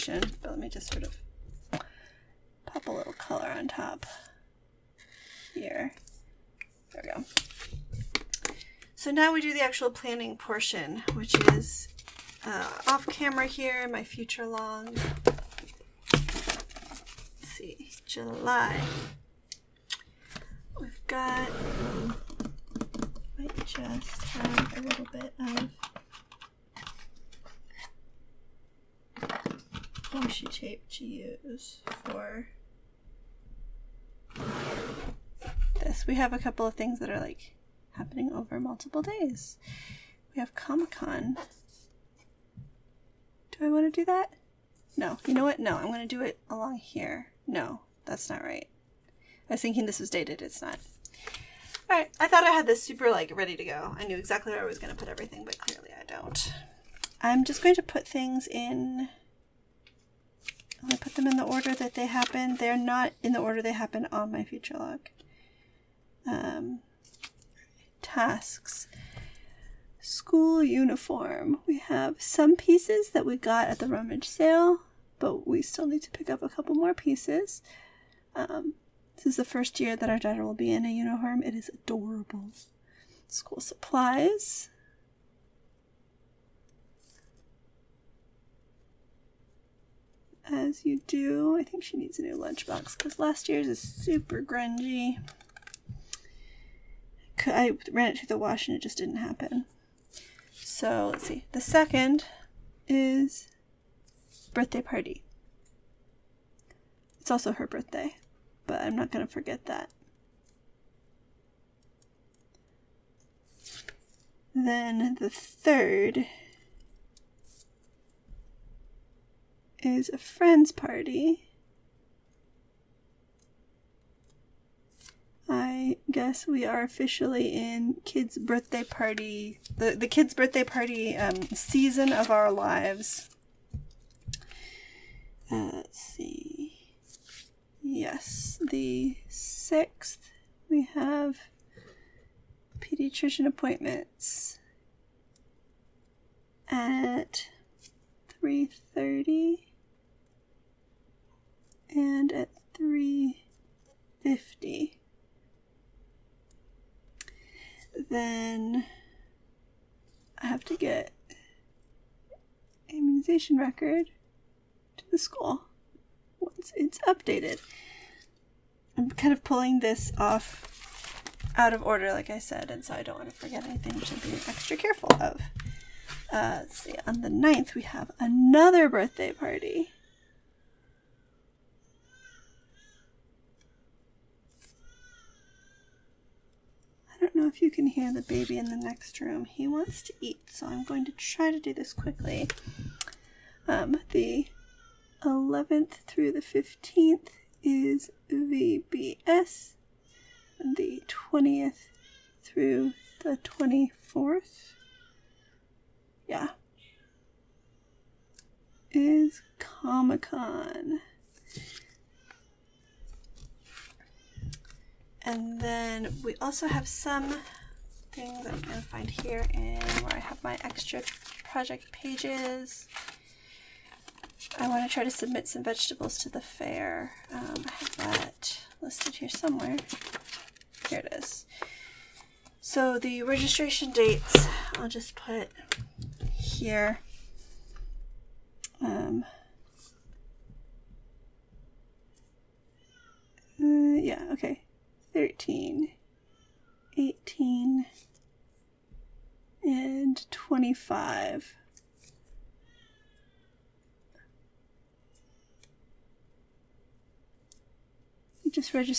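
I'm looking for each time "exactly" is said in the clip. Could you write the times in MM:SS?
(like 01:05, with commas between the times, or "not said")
00:54.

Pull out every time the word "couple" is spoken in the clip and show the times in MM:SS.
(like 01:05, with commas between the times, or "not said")
00:36, 01:16.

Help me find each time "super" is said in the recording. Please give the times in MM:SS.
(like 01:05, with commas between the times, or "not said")
00:52, 01:33.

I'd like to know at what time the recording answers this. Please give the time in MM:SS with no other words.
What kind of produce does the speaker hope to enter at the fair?
03:45.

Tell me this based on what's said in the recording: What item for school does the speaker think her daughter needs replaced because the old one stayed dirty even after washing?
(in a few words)
Lunchbox.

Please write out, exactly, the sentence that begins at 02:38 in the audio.
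Then I have to get immunization record to the school once it's updated.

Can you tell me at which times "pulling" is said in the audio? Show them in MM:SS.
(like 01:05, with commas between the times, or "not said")
02:49.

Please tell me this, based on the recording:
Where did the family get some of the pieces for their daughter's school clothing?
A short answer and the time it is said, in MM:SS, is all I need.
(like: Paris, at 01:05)
Rummage sale, at 01:13.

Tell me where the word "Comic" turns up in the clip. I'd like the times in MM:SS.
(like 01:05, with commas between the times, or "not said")
00:40, 03:29.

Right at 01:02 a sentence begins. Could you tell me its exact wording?
They're not in the order they happen on my future log.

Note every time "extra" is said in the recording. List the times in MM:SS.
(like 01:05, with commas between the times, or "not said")
02:54, 03:40.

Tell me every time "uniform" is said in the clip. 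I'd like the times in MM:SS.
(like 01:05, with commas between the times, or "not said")
01:10, 01:20.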